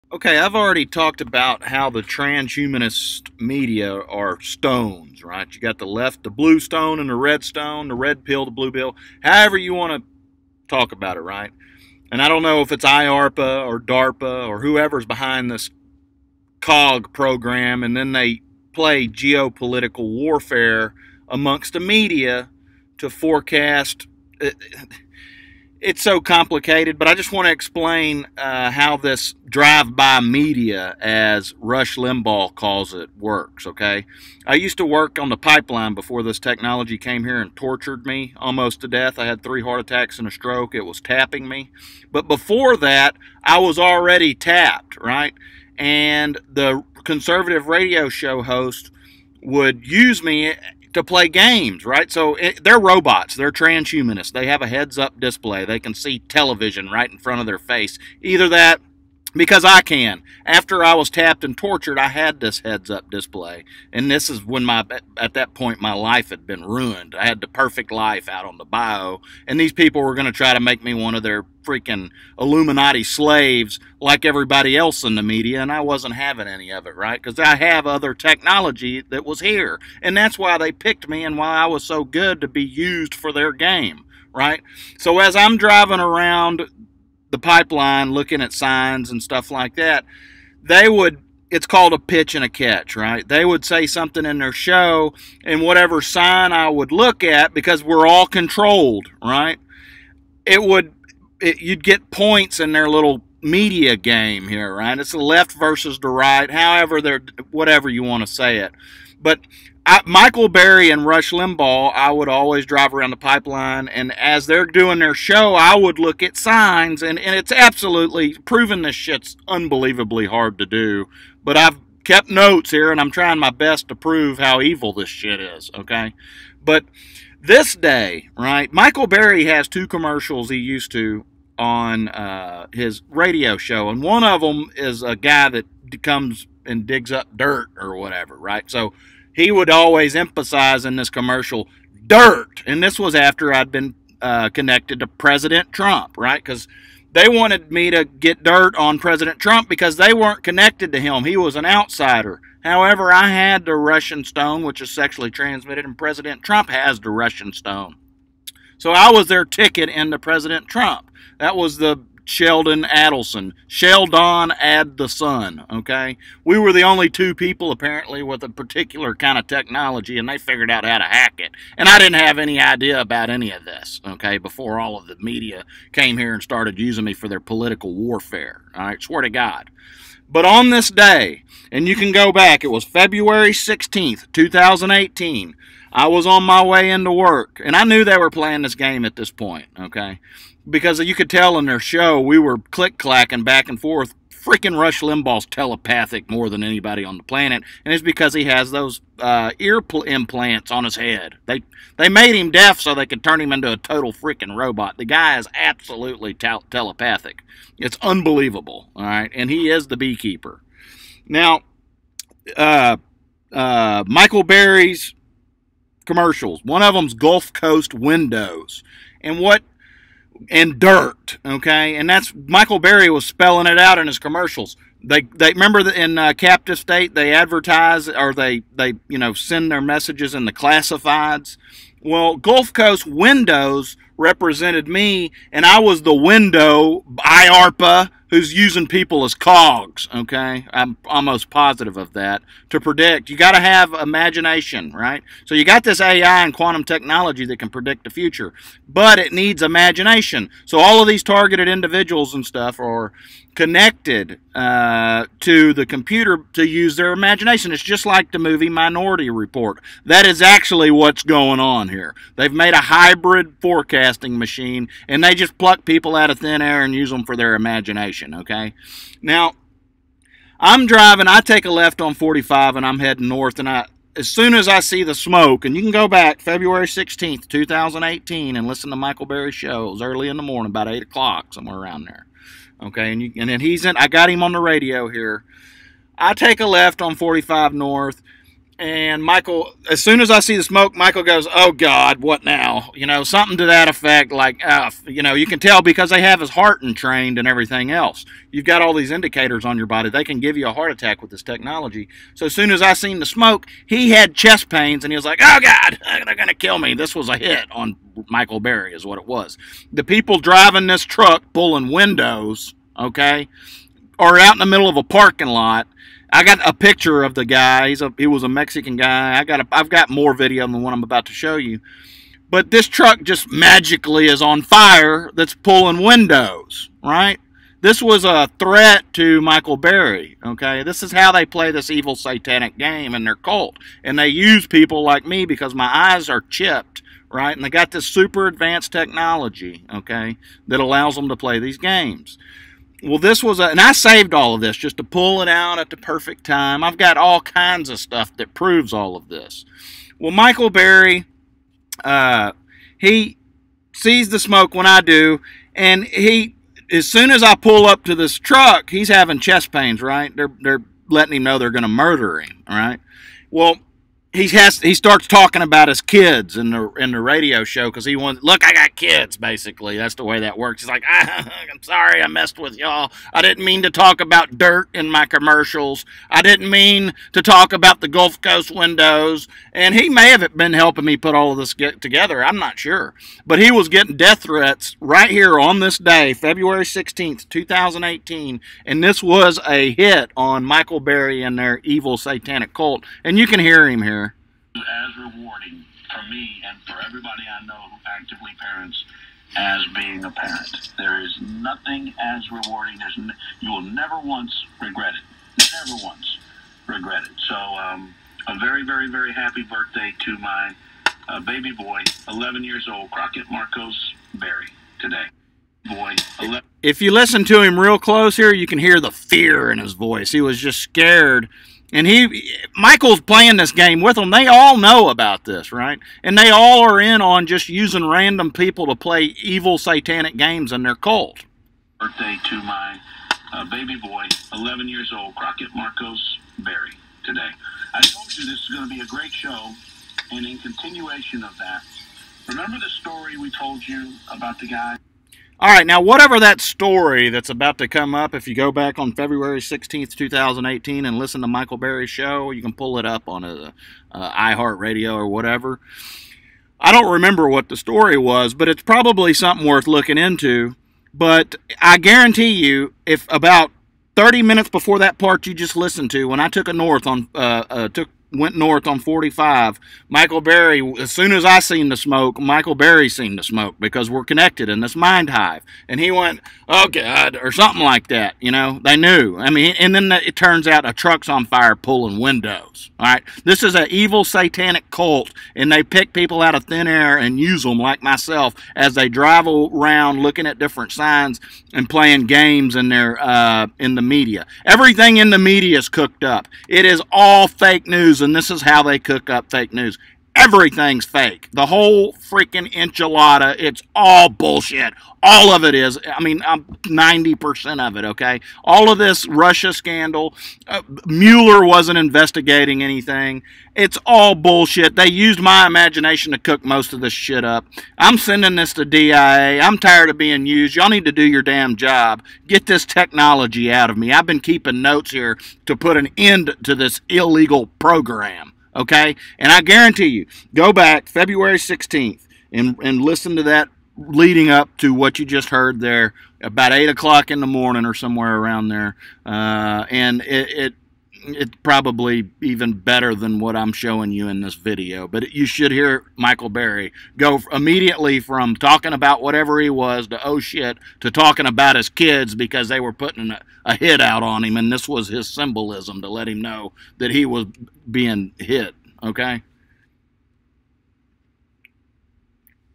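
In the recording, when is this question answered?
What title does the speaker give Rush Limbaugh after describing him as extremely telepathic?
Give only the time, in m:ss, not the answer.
3:29.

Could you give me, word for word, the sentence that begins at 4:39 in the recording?
It was early in the morning, about 8 o'clock, somewhere around there.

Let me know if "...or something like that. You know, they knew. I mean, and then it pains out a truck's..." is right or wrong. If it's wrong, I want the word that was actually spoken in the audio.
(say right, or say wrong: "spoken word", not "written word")
wrong: "turns", not "pains".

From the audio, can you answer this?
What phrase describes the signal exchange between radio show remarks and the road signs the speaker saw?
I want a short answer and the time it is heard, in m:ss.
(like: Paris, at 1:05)
a pitch and a catch, at 1:31.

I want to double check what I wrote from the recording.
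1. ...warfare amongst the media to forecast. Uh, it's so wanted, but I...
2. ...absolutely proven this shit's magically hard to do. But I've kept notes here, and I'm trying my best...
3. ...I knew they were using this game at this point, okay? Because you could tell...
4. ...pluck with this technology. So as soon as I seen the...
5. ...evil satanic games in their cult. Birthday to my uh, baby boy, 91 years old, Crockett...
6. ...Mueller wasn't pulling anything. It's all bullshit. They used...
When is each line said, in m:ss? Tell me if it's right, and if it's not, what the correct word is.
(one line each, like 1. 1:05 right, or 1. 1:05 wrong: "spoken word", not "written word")
1. 0:20 wrong: "complicated", not "wanted"
2. 1:57 wrong: "unbelievably", not "magically"
3. 3:07 wrong: "playing", not "using"
4. 5:00 wrong: "attack", not "pluck"
5. 7:09 wrong: "11", not "91"
6. 8:31 wrong: "investigating", not "pulling".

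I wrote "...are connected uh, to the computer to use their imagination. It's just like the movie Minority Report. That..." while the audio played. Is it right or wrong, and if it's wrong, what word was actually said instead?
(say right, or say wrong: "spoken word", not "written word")
right.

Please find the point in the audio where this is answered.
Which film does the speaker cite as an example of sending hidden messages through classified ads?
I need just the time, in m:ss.
3:46.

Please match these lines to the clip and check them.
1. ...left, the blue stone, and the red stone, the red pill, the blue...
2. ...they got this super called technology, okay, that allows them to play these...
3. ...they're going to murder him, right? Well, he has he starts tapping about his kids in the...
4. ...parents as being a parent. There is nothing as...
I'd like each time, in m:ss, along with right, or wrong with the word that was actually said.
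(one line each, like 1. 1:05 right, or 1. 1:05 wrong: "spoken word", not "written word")
1. 0:05 right
2. 5:37 wrong: "advanced", not "called"
3. 6:01 wrong: "talking", not "tapping"
4. 6:38 right.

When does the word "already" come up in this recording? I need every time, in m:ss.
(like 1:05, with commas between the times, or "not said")
0:00, 0:43.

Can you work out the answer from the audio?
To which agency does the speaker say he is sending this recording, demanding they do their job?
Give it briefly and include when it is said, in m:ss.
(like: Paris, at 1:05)
DIA, at 8:38.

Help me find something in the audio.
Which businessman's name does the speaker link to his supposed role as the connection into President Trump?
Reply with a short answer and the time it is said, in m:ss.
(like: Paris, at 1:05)
Sheldon Adelson, at 2:42.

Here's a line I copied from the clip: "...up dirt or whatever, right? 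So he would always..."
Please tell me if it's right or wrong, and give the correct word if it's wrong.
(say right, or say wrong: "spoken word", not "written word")
right.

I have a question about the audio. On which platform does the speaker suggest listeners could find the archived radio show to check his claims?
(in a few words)
iHeartRadio.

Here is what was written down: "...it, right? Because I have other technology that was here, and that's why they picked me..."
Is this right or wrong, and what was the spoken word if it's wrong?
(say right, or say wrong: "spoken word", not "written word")
right.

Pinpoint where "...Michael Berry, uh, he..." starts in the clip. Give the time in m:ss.
5:50.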